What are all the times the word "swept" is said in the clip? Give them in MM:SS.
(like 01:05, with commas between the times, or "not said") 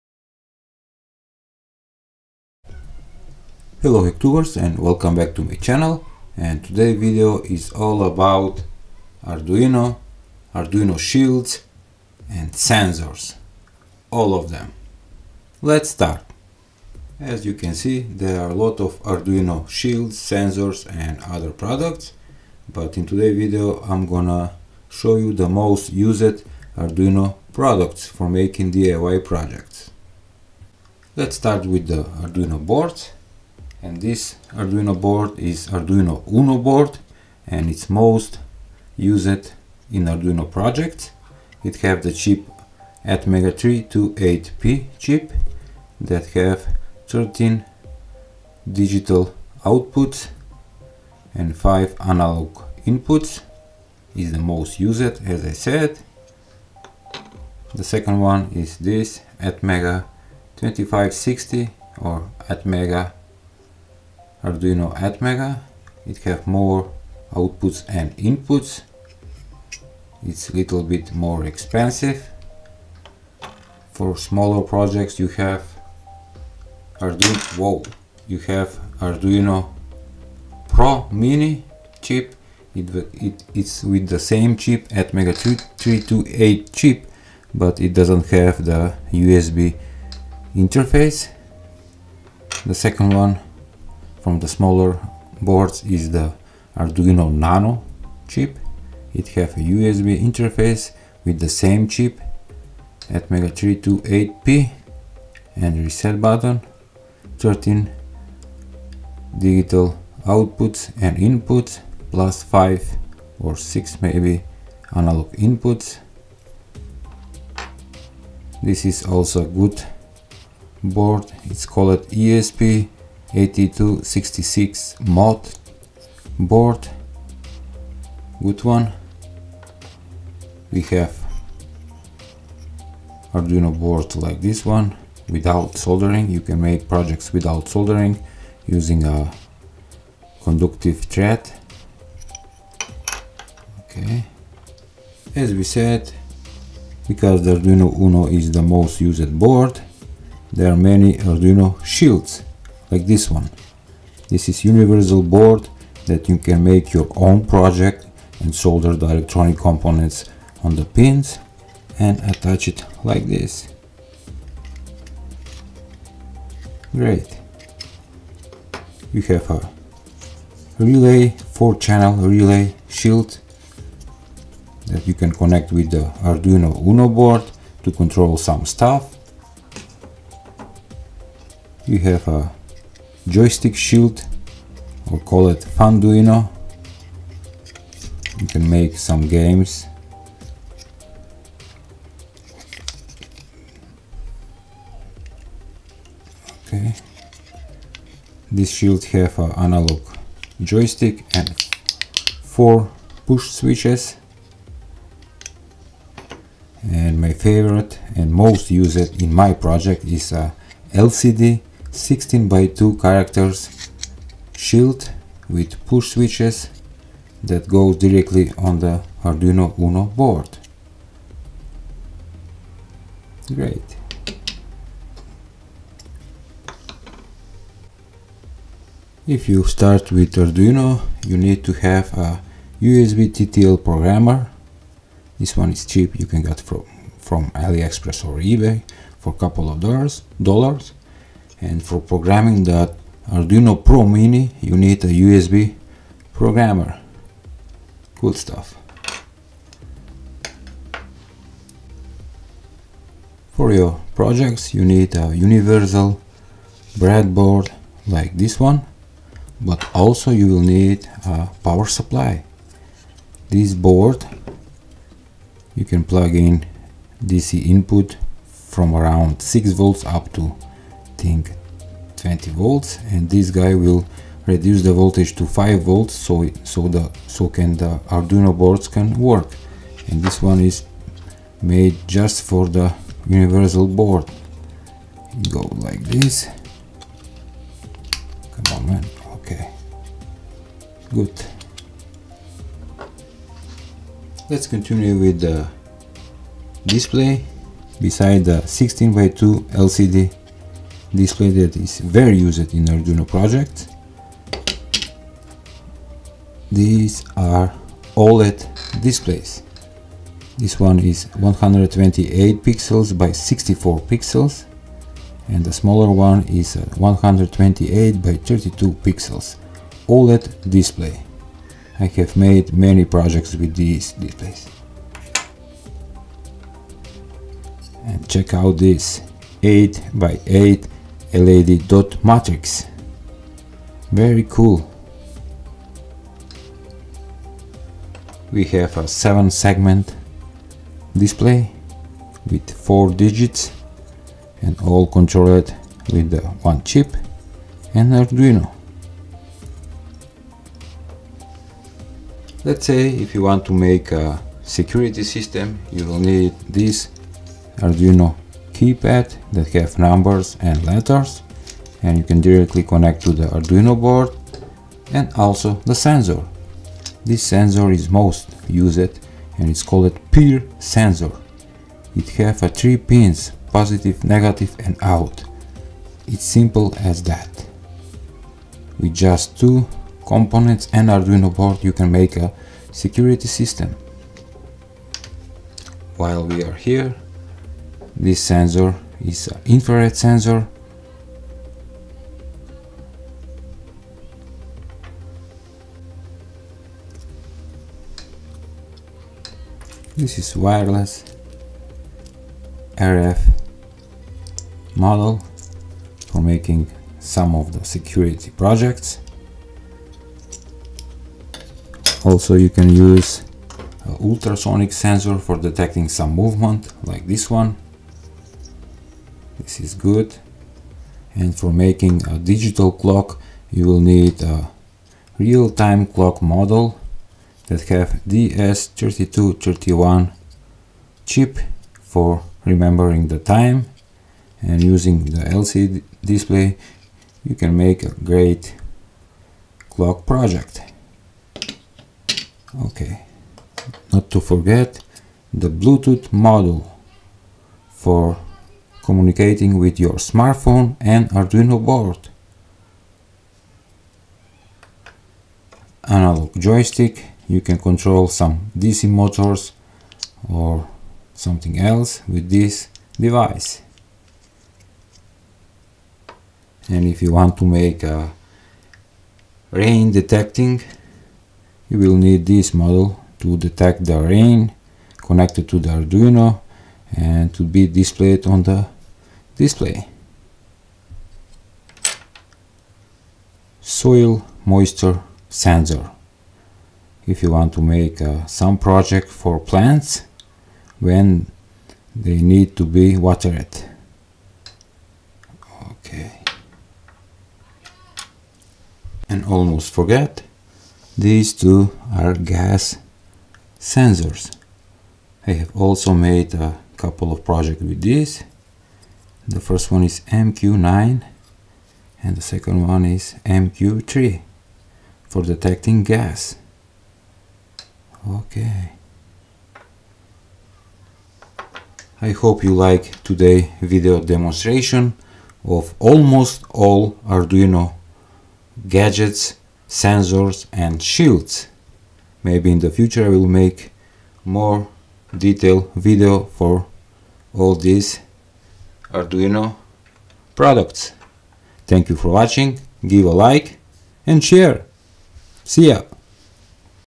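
not said.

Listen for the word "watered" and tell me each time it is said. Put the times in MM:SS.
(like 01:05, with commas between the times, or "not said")
08:13.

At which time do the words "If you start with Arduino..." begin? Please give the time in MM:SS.
03:49.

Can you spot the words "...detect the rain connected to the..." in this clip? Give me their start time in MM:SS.
07:53.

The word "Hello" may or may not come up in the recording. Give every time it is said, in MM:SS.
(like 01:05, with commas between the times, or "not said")
00:03.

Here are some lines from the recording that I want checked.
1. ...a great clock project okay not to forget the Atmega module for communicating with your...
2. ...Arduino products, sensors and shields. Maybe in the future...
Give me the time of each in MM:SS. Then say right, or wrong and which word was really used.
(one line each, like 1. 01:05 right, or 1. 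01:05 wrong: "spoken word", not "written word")
1. 07:18 wrong: "Bluetooth", not "Atmega"
2. 08:47 wrong: "gadgets", not "products".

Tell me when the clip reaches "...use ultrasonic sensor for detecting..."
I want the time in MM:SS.
06:52.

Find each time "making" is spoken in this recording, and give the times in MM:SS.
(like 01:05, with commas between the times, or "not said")
00:28, 06:46, 07:01.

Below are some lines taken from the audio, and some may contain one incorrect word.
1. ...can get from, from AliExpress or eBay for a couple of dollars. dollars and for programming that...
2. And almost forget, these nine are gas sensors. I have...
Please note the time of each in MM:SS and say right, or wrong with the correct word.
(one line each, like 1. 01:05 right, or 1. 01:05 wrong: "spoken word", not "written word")
1. 03:56 right
2. 08:19 wrong: "two", not "nine".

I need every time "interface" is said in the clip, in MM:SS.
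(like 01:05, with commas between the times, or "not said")
01:30, 01:40.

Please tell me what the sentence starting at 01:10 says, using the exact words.
It's a little bit more expensive.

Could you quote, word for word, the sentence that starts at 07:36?
Analog joystick, you can control some DC motors or something else with this device.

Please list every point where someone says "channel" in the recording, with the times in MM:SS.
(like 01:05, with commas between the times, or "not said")
00:05, 02:51.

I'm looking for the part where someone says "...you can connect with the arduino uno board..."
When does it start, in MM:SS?
02:55.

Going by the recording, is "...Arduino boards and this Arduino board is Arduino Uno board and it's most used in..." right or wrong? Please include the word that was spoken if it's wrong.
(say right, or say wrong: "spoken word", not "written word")
right.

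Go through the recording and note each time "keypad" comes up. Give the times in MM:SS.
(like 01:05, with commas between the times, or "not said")
05:58.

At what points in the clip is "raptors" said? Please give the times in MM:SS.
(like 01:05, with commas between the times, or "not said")
not said.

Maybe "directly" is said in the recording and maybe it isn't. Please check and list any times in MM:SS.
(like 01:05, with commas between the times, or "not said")
03:37, 06:02.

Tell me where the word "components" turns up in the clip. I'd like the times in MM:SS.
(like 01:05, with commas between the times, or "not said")
02:39, 06:20.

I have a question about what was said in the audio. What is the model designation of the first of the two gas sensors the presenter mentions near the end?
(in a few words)
MQ9.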